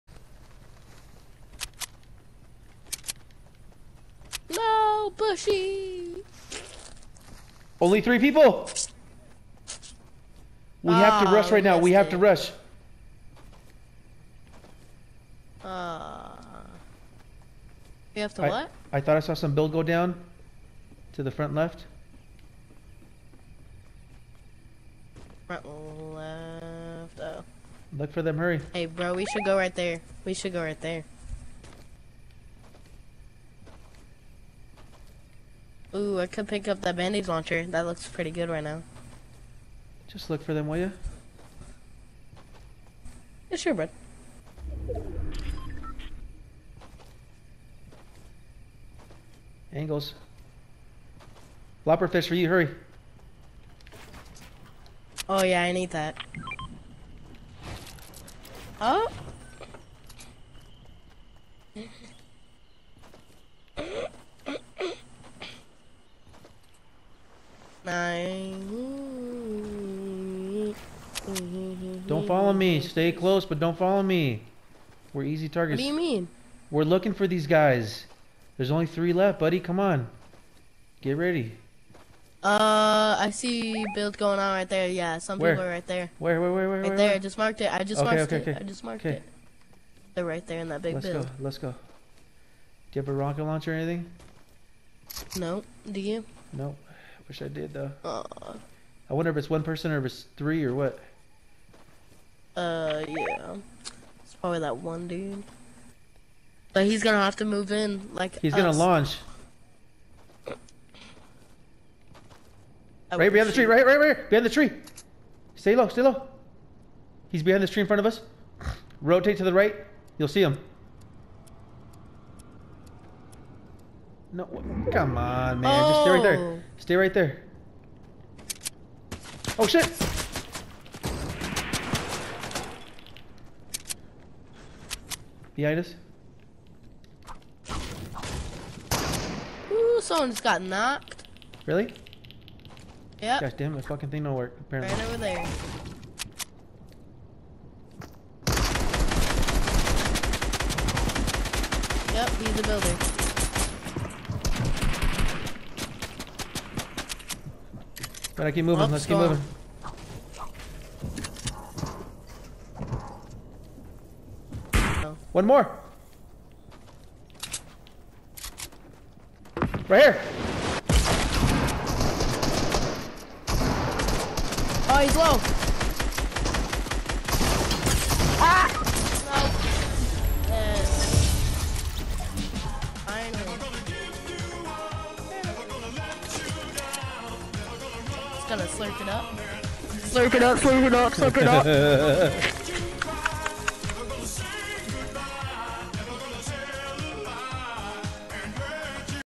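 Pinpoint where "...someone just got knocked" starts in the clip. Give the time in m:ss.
2:20.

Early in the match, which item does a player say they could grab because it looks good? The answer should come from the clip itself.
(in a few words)
bandage launcher.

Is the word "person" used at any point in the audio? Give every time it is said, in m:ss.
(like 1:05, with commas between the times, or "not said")
1:39.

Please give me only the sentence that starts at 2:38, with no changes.
But I keep moving, let's keep moving.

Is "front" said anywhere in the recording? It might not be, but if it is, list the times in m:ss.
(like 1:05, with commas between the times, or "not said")
0:21, 0:25, 1:57.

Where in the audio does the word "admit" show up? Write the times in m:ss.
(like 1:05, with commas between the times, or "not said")
not said.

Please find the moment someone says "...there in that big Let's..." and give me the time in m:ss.
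1:30.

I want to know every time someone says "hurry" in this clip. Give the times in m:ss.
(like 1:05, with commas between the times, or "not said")
0:28, 0:52.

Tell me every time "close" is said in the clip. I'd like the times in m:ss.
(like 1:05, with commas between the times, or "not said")
1:13.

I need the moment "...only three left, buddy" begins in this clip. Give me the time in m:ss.
1:18.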